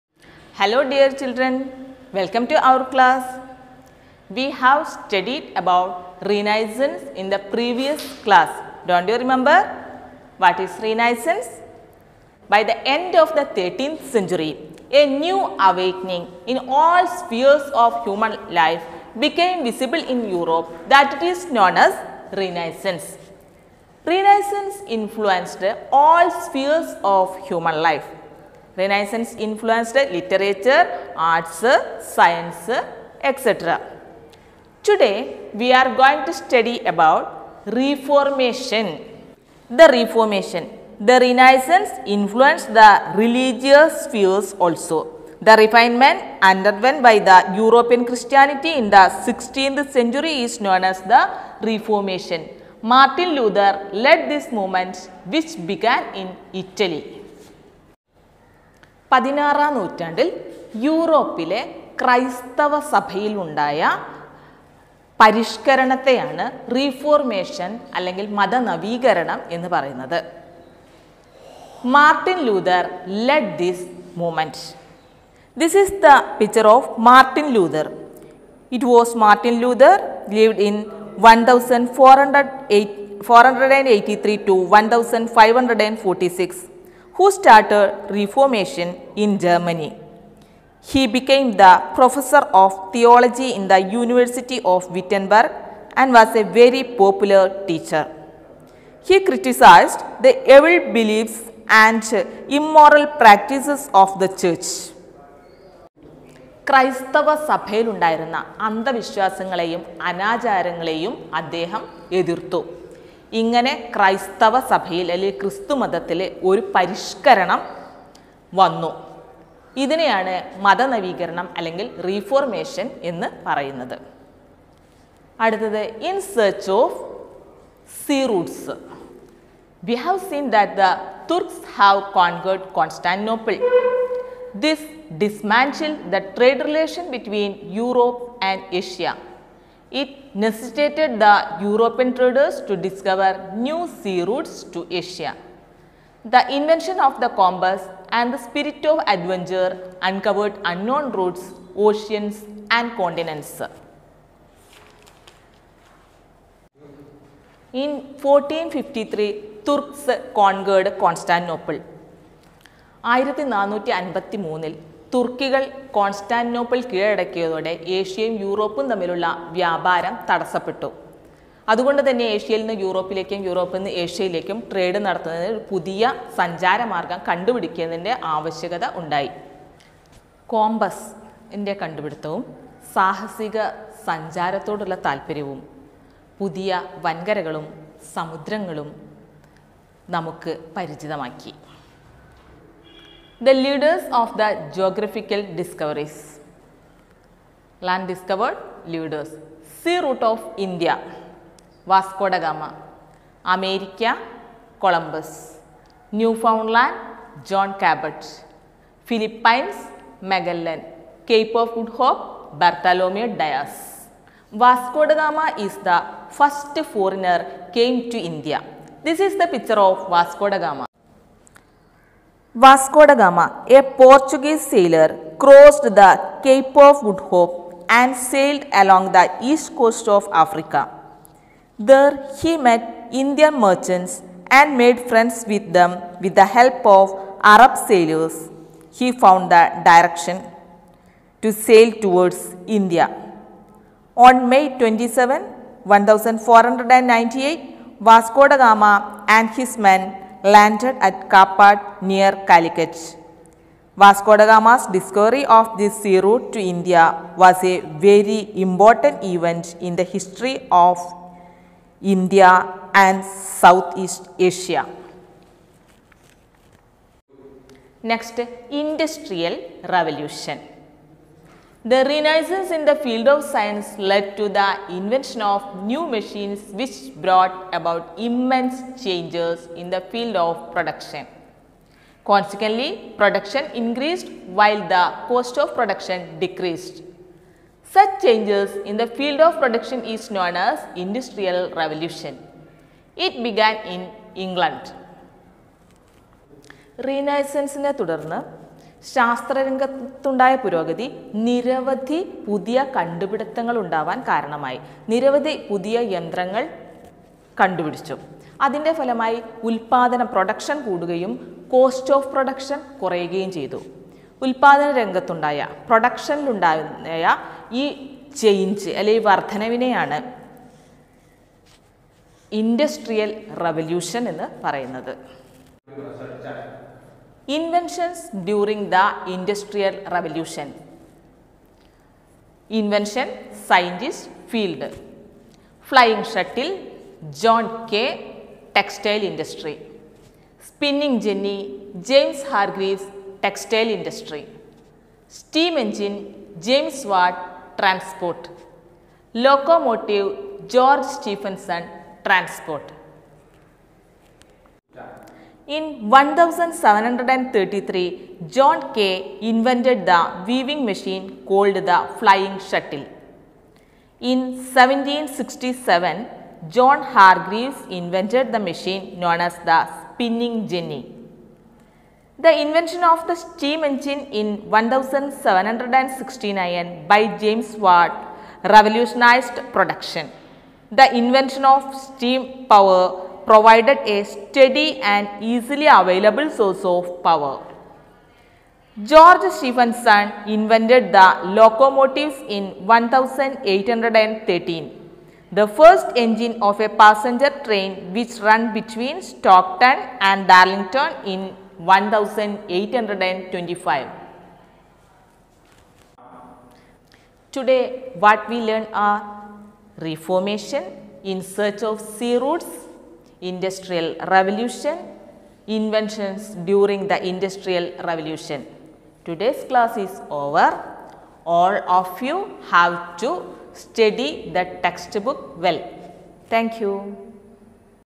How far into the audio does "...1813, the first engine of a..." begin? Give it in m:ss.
6:32.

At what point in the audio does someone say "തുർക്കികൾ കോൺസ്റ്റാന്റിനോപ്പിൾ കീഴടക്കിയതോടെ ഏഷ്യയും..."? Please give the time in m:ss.
2:45.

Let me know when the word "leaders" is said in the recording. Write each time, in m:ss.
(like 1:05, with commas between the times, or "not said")
3:13, 3:18.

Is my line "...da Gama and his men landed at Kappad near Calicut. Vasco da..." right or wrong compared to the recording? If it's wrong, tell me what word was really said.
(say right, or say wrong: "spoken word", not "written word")
right.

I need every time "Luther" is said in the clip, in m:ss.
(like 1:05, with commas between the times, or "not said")
0:53.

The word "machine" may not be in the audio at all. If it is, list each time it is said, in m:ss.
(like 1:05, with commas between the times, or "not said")
4:36, 6:00, 6:08.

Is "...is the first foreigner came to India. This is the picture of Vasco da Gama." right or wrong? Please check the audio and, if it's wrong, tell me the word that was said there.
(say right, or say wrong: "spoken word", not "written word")
right.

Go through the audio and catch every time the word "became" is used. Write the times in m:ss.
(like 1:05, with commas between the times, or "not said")
0:19, 1:31.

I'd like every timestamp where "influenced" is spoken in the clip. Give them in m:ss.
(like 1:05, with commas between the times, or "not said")
0:24, 0:29, 0:42.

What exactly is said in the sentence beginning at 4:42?
Consequently, production increased while the cost of production decreased.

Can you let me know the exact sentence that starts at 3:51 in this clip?
There he met Indian merchants and made friends with them with the help of Arab sailors.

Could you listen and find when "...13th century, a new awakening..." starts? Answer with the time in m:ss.
0:13.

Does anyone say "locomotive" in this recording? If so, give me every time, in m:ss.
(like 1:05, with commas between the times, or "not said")
5:49, 6:31.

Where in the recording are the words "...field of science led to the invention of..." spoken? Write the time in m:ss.
4:32.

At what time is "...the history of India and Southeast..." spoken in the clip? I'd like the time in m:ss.
4:19.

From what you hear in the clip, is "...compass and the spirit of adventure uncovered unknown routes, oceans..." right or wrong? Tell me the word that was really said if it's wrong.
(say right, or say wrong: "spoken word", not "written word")
right.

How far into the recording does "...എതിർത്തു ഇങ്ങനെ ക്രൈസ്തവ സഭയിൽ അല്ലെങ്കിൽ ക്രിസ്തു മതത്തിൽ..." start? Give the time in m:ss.
1:52.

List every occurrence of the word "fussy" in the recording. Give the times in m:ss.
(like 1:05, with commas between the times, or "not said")
not said.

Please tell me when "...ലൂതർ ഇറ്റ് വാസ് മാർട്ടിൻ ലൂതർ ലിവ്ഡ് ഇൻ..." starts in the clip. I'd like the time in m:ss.
1:17.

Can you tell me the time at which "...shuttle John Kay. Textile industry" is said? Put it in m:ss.
5:36.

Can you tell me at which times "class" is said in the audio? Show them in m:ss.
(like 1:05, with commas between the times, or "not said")
0:02, 0:08, 6:59.